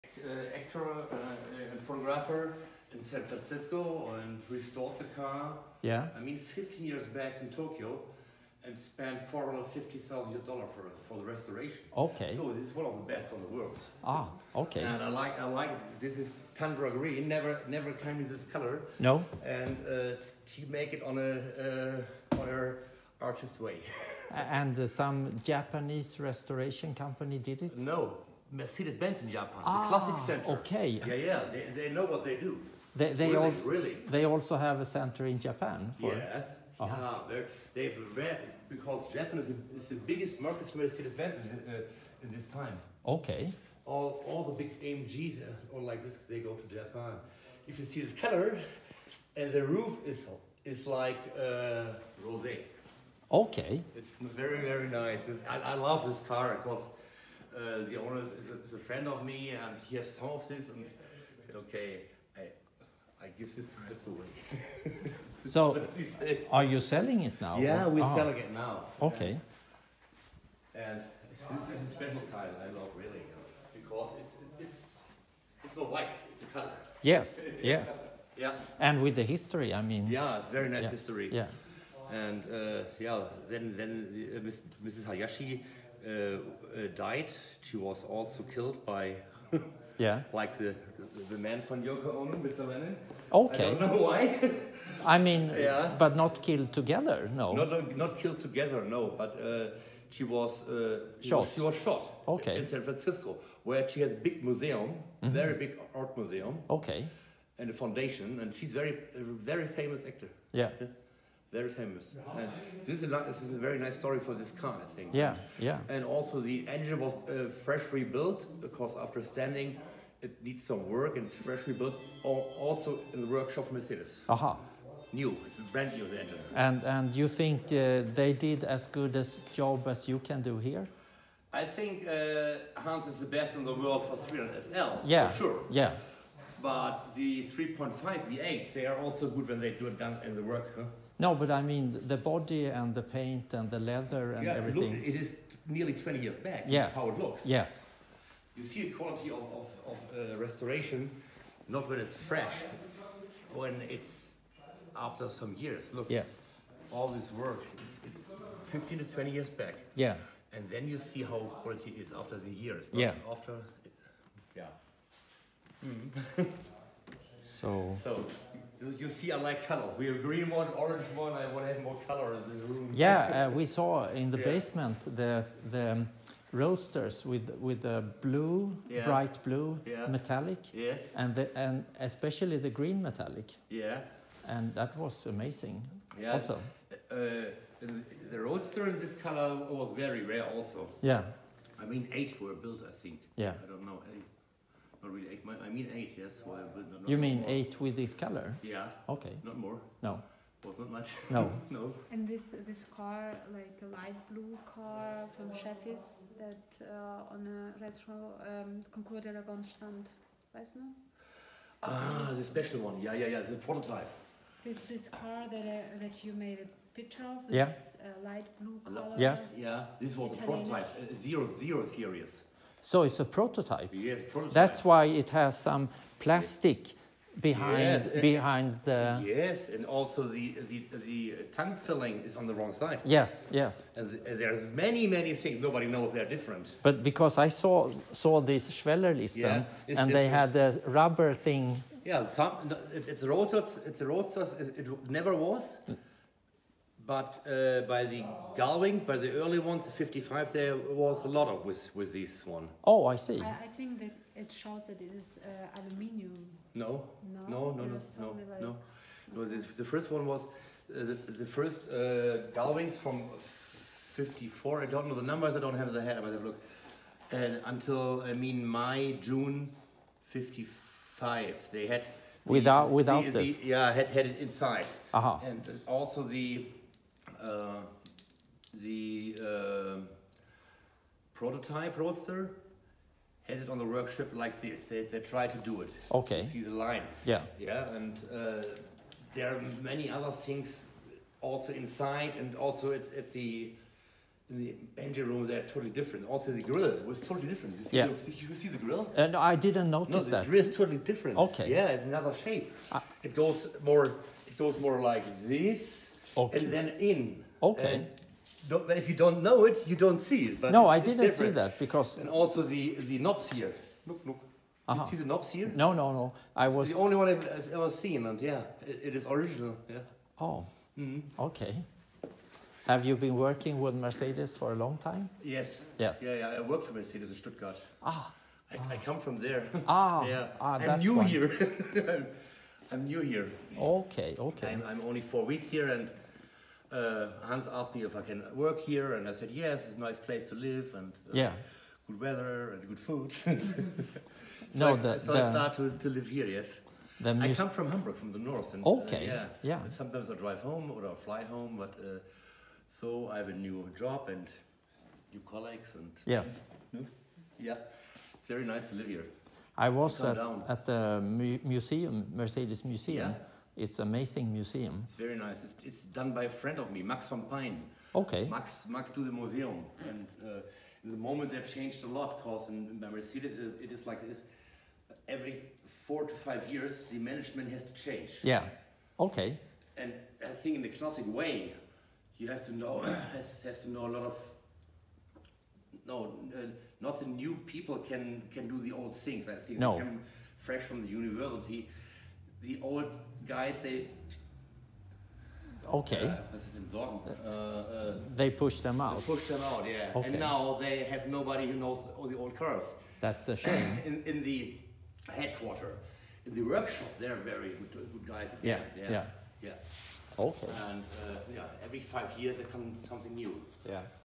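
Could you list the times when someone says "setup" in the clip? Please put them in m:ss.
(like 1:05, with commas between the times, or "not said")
not said.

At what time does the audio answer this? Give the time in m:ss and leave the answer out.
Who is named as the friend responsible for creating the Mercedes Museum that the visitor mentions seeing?
6:07.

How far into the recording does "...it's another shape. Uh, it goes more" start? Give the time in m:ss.
5:01.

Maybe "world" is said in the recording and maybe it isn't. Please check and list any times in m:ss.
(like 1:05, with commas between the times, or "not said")
0:13, 2:13.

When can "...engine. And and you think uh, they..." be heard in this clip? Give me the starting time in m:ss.
2:06.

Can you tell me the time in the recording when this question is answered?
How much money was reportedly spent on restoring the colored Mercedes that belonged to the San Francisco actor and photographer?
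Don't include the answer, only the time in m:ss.
0:09.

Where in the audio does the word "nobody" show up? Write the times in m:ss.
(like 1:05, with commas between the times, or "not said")
3:55, 6:41.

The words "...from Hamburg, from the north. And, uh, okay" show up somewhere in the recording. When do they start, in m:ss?
5:47.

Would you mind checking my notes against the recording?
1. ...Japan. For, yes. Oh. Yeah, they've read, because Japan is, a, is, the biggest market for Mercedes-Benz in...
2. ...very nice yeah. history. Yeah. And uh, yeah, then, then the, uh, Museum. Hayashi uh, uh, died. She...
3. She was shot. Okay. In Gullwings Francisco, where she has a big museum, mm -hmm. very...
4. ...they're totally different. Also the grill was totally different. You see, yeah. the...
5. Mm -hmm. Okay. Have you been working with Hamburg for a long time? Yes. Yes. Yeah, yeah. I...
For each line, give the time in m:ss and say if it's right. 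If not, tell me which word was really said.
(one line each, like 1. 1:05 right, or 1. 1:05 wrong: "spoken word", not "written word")
1. 0:35 right
2. 1:20 wrong: "Mrs", not "Museum"
3. 1:41 wrong: "San", not "Gullwings"
4. 4:55 right
5. 5:20 wrong: "Mercedes", not "Hamburg".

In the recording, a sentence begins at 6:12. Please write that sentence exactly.
Because in, Mercedes, it is like this: every four to five years, the management has to change.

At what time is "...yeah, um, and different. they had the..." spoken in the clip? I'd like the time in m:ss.
3:59.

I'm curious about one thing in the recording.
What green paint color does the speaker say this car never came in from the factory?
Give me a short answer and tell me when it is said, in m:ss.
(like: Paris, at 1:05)
Tundra Green, at 0:16.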